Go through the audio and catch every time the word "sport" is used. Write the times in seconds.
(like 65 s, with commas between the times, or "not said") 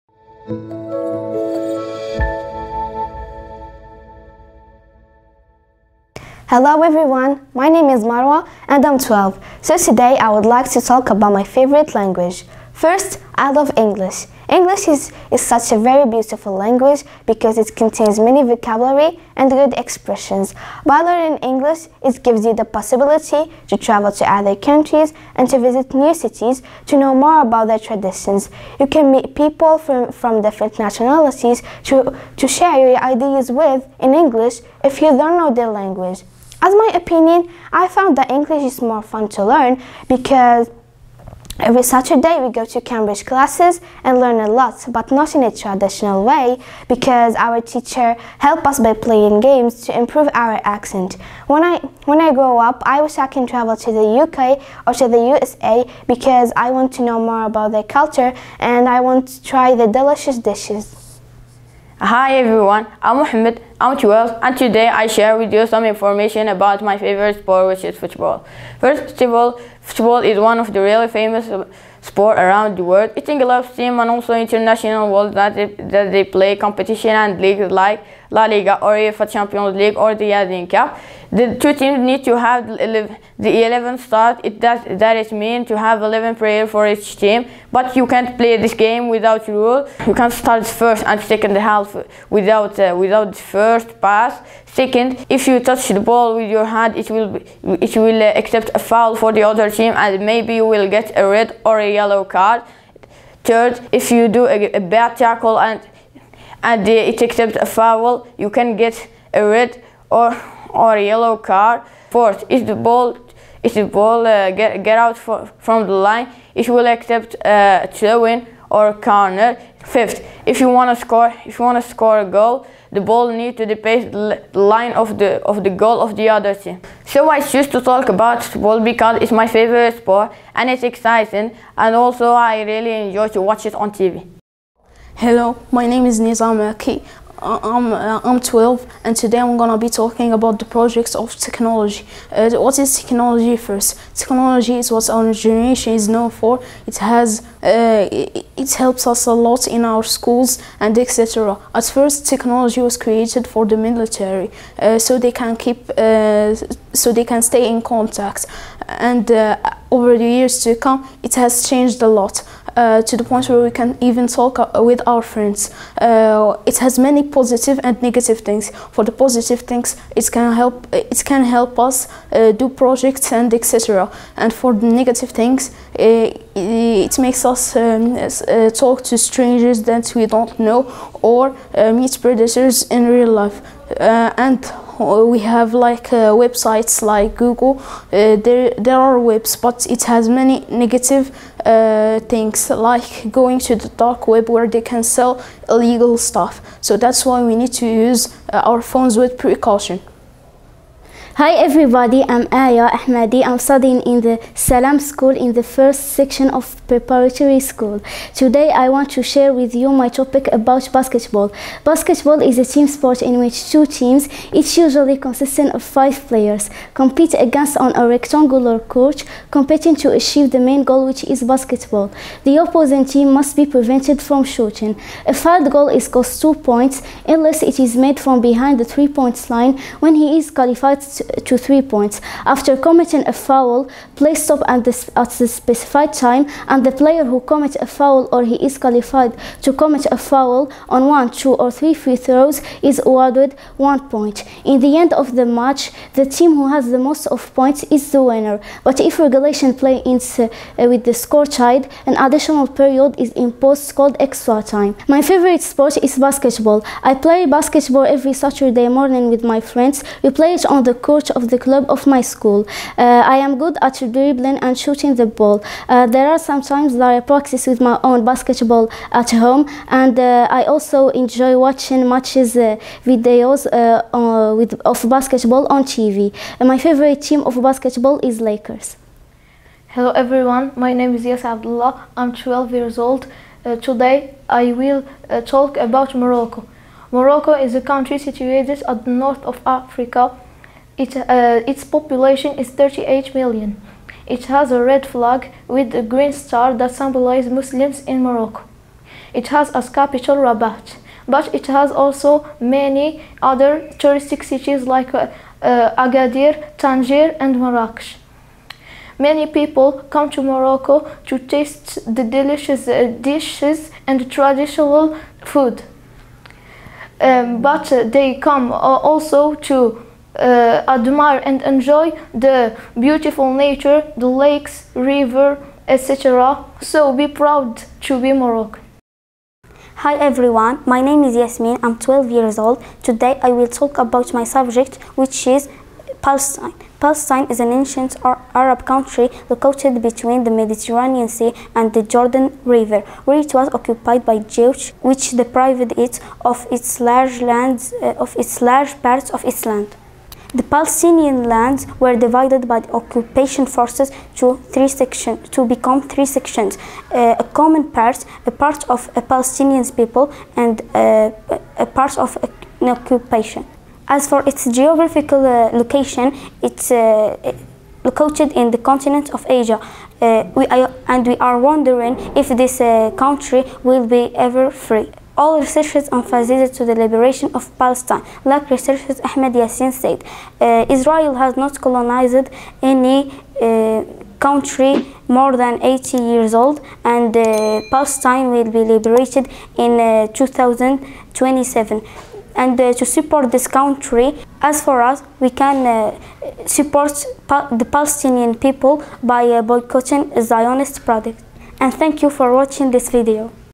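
67 s, 72 s, 129 s, 212 s, 255 s.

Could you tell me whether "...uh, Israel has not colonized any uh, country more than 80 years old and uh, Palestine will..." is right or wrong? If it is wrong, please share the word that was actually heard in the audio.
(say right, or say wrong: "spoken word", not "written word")
right.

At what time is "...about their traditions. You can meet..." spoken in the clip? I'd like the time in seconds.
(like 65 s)
27 s.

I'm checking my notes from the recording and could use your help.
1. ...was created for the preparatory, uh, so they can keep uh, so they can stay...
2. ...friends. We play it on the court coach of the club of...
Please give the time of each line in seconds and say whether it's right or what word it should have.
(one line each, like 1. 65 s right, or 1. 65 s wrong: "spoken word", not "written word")
1. 152 s wrong: "military", not "preparatory"
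2. 259 s right.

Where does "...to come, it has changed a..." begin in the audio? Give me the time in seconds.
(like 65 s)
160 s.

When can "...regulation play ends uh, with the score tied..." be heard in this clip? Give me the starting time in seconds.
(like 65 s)
249 s.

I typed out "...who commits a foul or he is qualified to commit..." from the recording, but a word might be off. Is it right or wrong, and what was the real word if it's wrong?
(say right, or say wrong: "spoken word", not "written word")
right.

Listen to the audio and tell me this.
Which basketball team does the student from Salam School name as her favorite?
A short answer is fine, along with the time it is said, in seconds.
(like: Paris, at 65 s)
Lakers, at 278 s.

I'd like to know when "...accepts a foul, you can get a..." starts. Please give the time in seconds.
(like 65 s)
107 s.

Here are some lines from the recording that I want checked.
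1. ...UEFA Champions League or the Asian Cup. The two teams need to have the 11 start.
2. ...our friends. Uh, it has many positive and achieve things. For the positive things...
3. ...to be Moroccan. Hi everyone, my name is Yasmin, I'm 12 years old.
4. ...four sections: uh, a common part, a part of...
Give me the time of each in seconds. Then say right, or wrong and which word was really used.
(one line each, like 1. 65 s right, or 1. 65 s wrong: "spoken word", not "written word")
1. 78 s right
2. 165 s wrong: "negative", not "achieve"
3. 328 s right
4. 356 s wrong: "three", not "four".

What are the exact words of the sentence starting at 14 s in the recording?
English is, is such a very beautiful language because it contains many vocabulary and good expressions.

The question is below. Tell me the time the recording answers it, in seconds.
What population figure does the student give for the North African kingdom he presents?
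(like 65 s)
292 s.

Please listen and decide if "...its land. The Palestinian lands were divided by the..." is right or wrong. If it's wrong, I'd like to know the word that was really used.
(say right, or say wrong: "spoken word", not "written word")
right.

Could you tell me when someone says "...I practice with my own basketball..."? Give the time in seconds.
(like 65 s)
267 s.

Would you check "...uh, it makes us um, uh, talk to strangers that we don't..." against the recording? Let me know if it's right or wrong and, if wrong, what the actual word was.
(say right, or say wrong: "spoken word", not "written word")
right.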